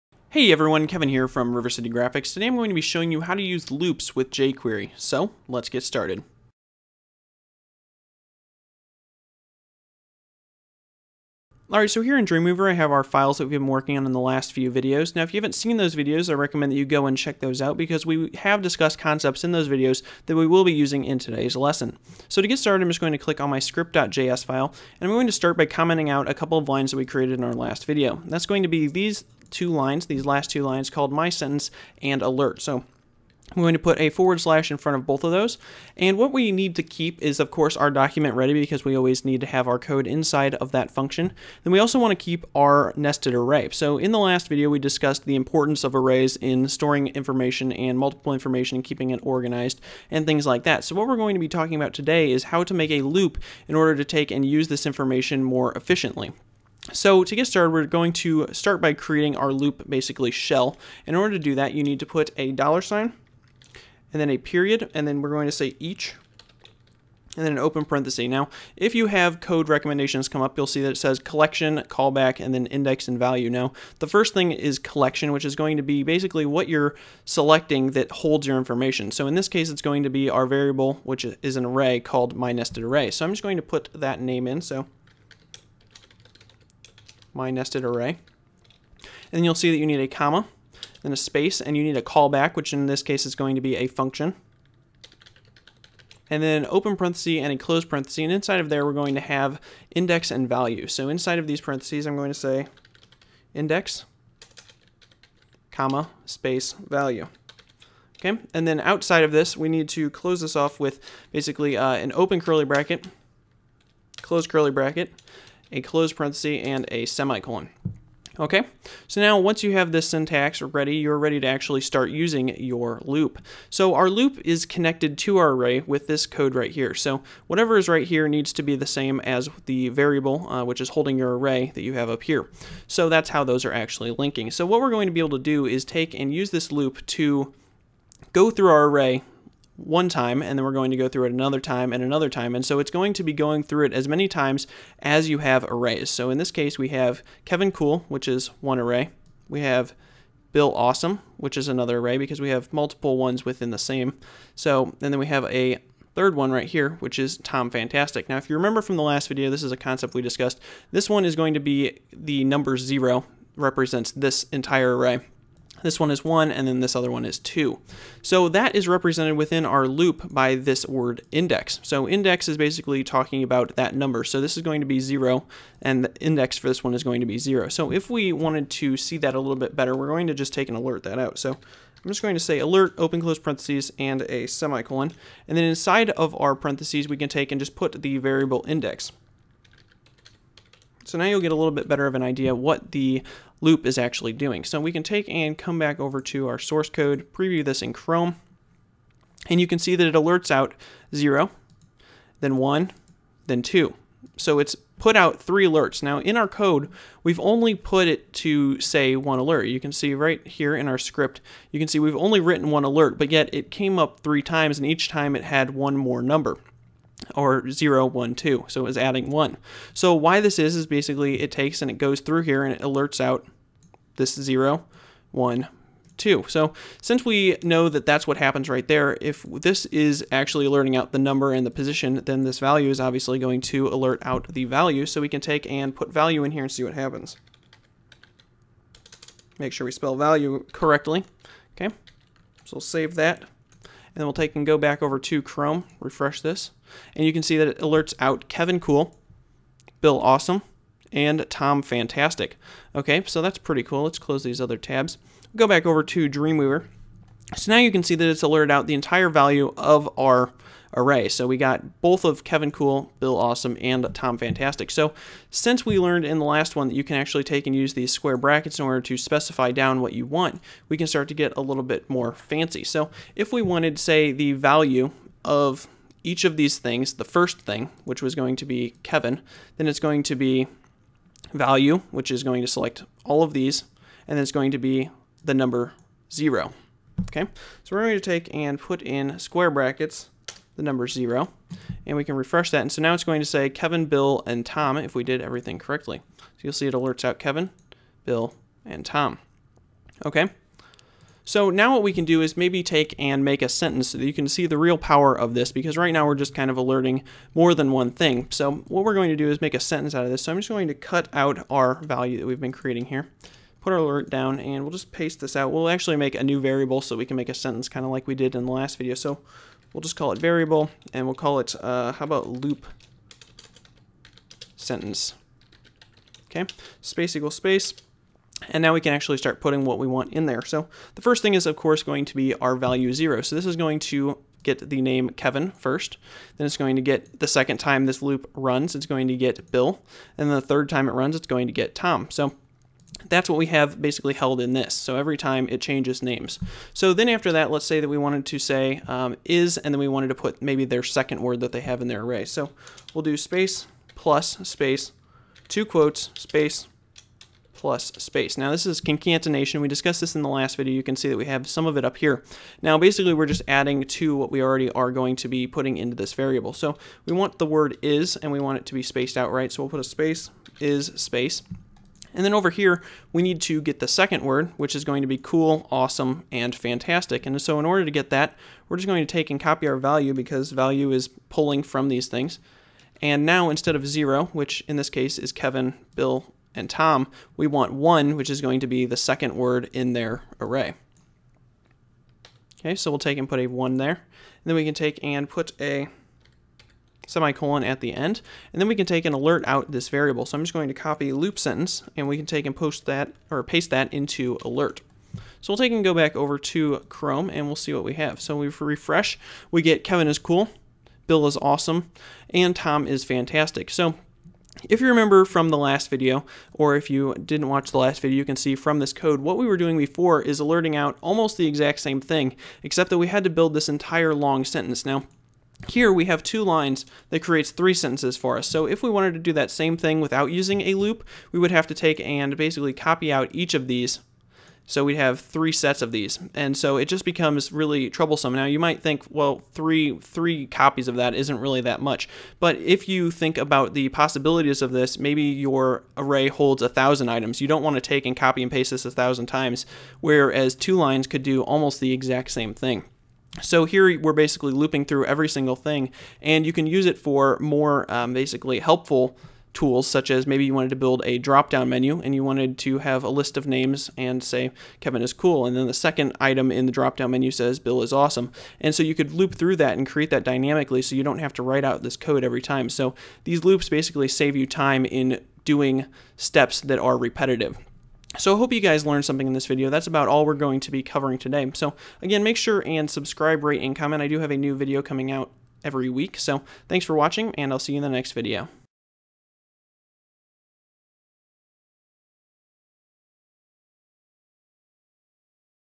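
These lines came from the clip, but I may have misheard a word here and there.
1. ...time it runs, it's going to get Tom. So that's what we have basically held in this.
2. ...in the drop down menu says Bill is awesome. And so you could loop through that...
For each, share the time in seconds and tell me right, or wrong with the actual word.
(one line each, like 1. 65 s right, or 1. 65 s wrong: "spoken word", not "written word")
1. 340 s right
2. 466 s right.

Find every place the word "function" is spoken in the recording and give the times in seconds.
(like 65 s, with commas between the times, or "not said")
40 s, 93 s.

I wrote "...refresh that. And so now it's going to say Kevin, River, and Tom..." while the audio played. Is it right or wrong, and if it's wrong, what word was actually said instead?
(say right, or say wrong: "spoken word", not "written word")
wrong: "Bill", not "River".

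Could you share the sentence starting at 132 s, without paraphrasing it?
So that's how those are actually linking.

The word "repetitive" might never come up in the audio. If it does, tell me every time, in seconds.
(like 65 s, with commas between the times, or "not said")
477 s.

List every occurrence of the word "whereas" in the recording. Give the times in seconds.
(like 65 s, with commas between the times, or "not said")
450 s.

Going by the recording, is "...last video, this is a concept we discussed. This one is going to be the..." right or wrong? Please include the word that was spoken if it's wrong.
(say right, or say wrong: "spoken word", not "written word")
right.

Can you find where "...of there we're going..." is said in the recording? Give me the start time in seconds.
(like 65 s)
98 s.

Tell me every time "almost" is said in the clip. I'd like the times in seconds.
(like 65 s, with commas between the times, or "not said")
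421 s, 451 s.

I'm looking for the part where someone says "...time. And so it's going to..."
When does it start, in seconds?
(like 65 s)
142 s.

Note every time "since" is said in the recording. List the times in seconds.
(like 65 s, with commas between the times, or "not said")
227 s, 265 s.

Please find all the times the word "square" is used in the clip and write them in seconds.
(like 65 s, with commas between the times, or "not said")
268 s, 289 s.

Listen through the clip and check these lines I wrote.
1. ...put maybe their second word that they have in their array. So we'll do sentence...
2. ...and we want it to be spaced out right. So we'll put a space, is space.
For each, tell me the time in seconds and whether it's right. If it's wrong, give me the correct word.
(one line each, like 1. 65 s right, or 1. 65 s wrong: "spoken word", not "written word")
1. 350 s wrong: "space", not "sentence"
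2. 368 s right.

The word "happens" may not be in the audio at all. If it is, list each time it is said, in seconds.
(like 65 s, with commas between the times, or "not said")
228 s, 236 s.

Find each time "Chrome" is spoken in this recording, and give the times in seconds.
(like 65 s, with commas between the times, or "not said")
197 s, 245 s, 407 s.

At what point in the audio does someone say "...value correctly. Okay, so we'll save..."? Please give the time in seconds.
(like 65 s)
240 s.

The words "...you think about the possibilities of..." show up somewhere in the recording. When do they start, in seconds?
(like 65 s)
443 s.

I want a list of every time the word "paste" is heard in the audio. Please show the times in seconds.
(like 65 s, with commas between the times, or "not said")
315 s, 403 s, 448 s.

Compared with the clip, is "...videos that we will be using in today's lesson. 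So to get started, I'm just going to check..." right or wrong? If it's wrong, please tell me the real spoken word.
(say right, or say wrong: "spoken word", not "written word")
wrong: "click", not "check".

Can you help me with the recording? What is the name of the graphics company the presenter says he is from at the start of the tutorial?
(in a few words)
River City Graphix.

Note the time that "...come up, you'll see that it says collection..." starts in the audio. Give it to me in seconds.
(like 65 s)
70 s.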